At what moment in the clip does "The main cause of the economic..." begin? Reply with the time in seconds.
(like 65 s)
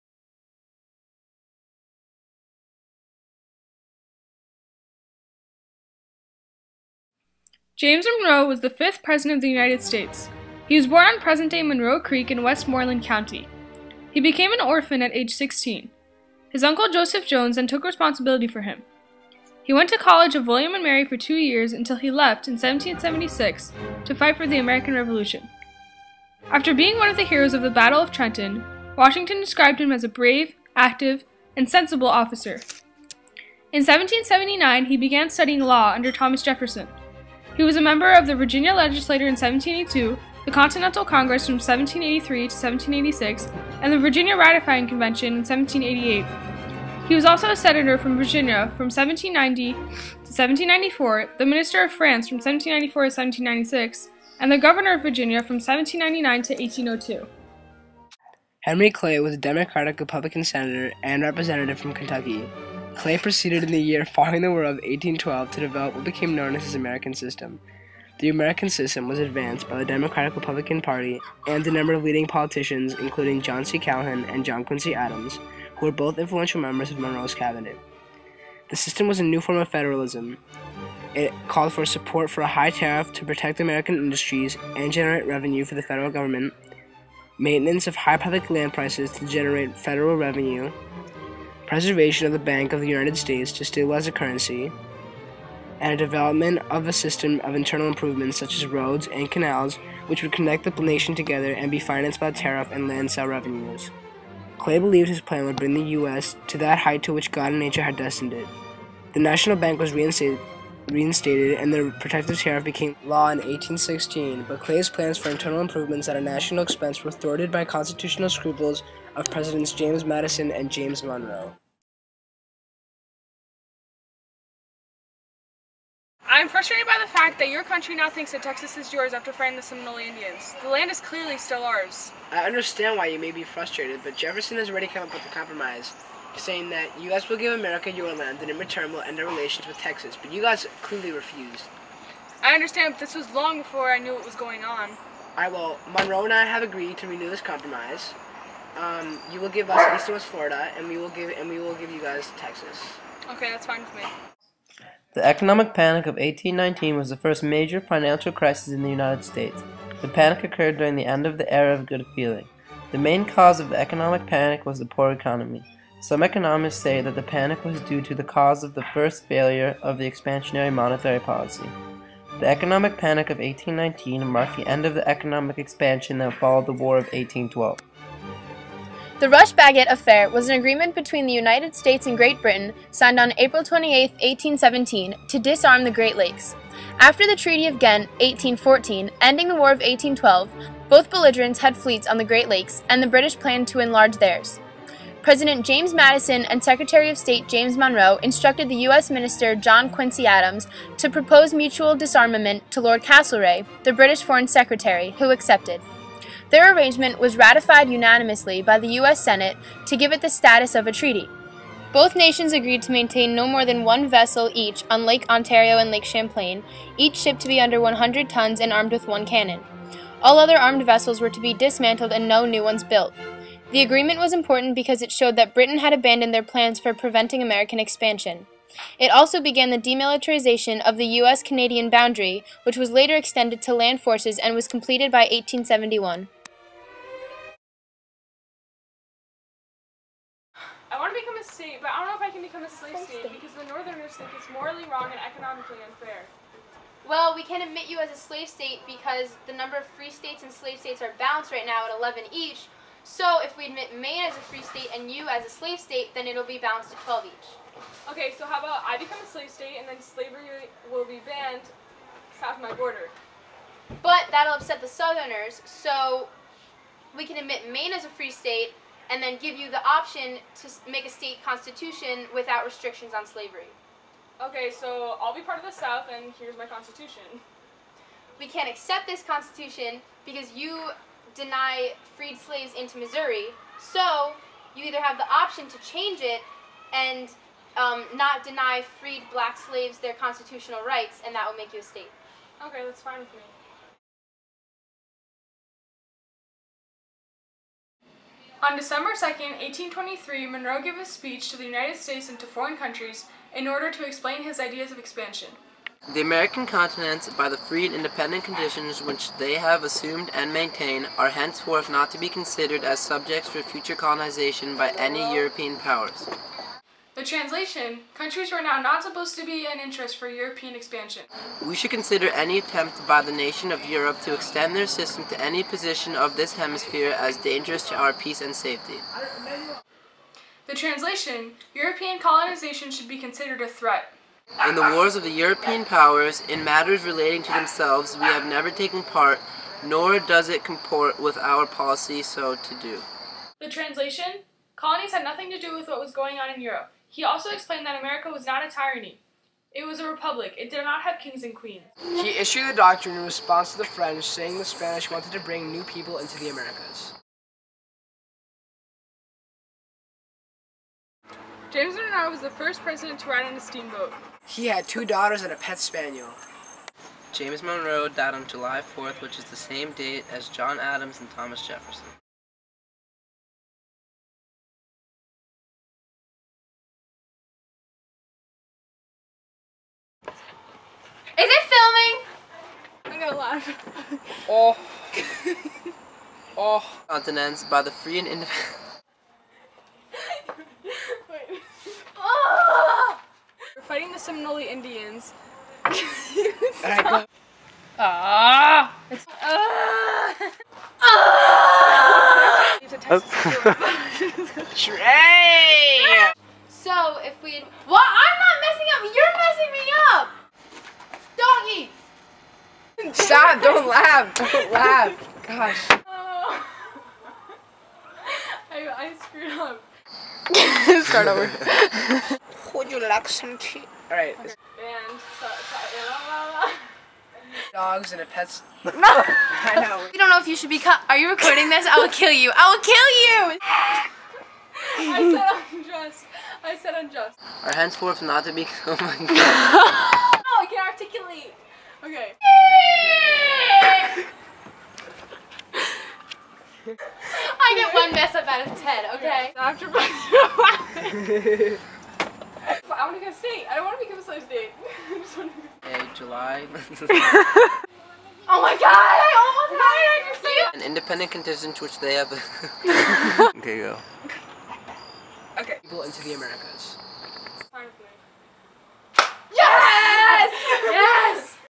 162 s.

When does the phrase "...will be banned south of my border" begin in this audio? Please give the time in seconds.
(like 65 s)
260 s.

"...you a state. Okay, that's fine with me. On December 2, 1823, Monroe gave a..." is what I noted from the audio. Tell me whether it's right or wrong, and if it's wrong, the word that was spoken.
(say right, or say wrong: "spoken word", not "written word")
right.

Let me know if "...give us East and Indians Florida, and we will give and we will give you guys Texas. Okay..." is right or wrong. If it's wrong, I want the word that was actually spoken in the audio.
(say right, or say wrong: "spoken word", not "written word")
wrong: "West", not "Indians".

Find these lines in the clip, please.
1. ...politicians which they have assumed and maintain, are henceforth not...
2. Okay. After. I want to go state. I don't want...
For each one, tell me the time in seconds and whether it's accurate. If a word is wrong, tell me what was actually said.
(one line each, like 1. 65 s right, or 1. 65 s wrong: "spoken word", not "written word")
1. 308 s wrong: "conditions", not "politicians"
2. 449 s right.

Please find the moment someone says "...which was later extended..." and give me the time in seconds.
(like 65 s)
232 s.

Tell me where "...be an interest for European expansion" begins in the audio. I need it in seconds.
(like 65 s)
319 s.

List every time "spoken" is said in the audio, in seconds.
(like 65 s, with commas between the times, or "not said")
not said.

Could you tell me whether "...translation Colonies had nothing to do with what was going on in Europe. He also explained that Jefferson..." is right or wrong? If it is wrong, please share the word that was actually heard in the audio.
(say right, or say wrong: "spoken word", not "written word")
wrong: "America", not "Jefferson".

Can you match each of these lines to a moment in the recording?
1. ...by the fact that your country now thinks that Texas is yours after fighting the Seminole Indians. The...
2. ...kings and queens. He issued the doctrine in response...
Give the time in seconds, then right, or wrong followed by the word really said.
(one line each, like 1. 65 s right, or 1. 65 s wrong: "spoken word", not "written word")
1. 126 s right
2. 351 s right.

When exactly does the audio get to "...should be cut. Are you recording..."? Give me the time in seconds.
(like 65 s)
430 s.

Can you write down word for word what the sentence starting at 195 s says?
President James Madison and Secretary of State James Monroe instructed the U.S.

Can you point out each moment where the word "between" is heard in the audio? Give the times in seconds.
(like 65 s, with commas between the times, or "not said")
180 s.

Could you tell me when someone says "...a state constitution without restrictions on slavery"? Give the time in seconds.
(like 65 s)
271 s.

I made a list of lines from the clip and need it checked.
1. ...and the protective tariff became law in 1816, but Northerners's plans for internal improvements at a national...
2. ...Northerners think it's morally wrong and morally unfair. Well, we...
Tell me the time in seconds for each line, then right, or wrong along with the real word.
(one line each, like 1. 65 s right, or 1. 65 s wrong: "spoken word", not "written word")
1. 111 s wrong: "Clay", not "Northerners"
2. 243 s wrong: "economically", not "morally".